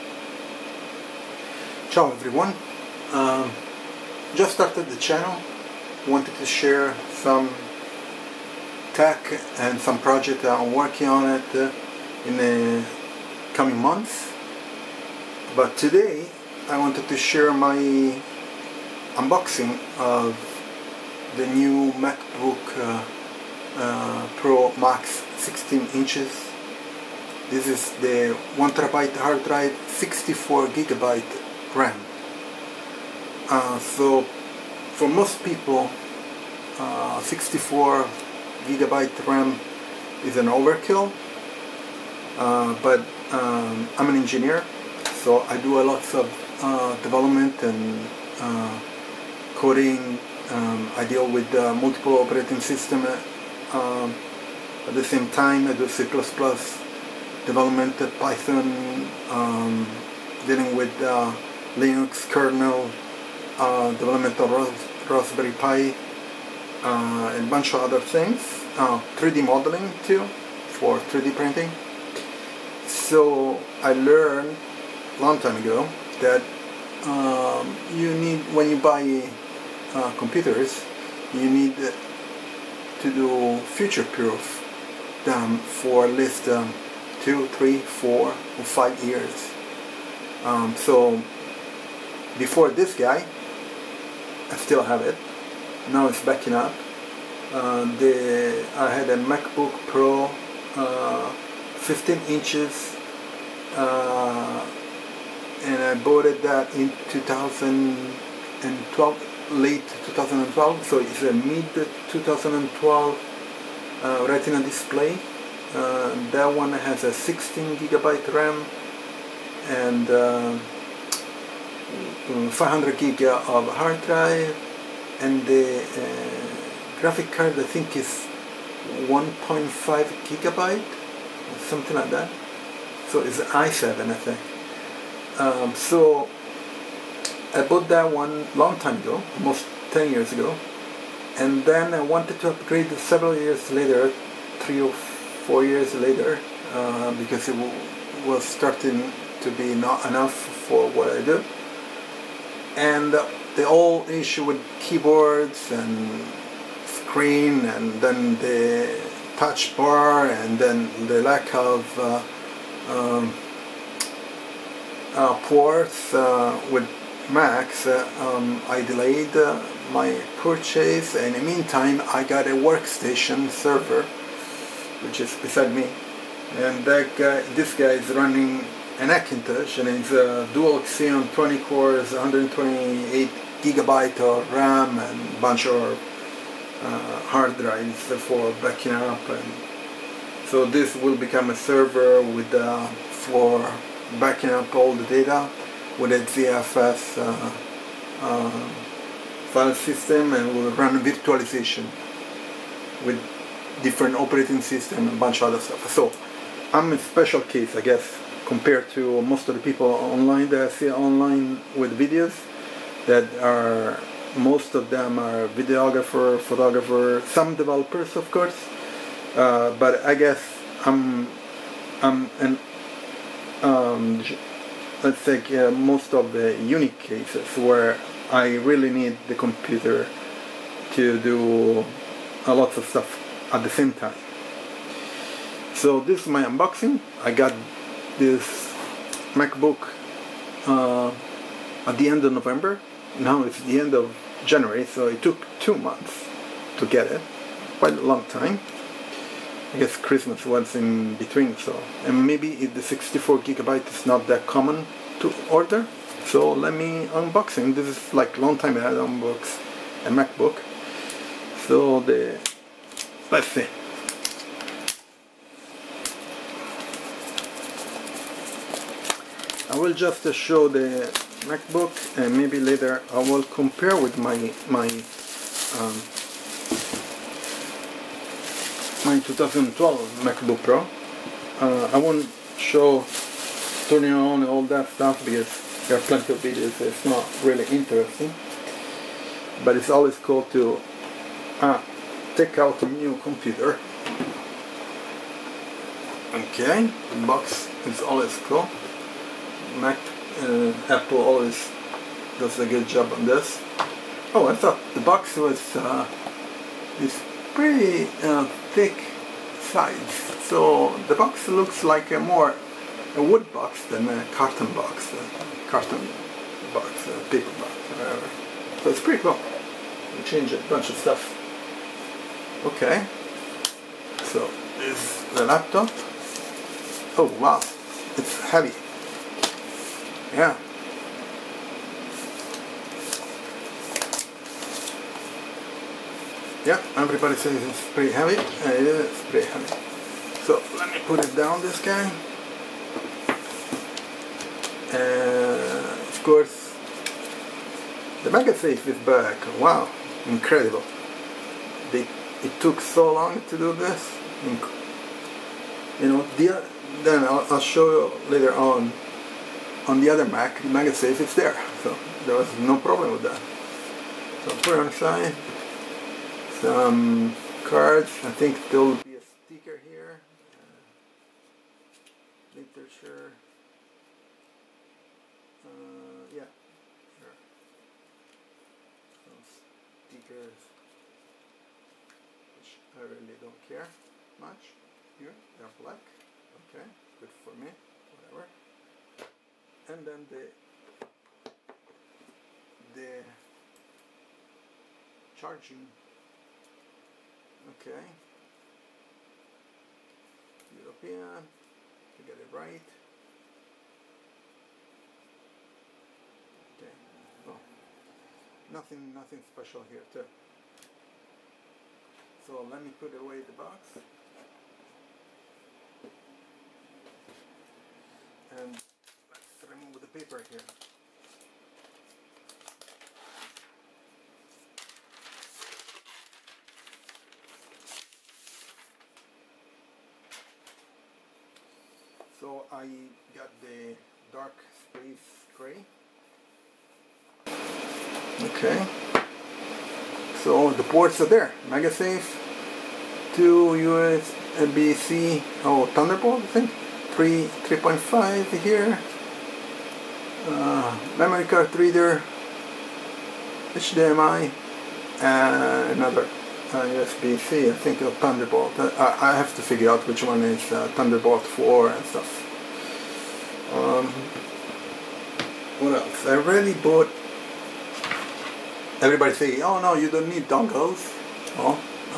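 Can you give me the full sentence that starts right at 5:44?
Uh, of course, the MagSafe is back.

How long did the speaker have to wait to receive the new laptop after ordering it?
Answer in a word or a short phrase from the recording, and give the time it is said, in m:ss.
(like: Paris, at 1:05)
2 months, at 4:05.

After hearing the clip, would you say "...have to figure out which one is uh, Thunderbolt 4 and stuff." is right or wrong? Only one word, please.
right.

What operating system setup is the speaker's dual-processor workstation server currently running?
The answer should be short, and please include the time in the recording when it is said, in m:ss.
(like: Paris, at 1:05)
Hackintosh, at 2:59.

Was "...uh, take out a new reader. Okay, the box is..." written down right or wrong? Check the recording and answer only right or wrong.
wrong.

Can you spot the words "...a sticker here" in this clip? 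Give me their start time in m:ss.
6:09.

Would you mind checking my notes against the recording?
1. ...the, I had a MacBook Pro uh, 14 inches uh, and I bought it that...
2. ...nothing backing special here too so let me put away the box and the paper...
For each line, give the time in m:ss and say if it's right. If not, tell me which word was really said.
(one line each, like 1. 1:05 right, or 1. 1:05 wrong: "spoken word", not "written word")
1. 1:37 wrong: "15", not "14"
2. 6:48 wrong: "nothing", not "backing".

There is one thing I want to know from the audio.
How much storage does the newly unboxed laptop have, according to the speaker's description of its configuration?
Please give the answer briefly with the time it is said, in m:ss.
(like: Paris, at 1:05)
1 terabyte, at 0:28.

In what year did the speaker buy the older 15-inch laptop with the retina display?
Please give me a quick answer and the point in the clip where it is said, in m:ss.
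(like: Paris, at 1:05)
2012, at 1:49.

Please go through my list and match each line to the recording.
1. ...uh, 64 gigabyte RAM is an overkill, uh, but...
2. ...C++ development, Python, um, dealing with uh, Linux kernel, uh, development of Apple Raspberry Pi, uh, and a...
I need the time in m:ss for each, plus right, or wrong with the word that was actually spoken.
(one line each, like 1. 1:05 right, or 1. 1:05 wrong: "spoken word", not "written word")
1. 0:36 right
2. 0:55 wrong: "Ros", not "Apple".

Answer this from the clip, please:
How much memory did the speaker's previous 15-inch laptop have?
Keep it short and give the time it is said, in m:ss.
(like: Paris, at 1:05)
16 gigabytes, at 1:57.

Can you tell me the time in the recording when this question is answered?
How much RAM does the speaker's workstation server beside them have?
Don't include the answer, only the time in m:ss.
3:02.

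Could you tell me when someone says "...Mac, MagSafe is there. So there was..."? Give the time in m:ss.
6:00.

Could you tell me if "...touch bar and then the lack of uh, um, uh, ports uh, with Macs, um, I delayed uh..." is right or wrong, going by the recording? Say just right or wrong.
right.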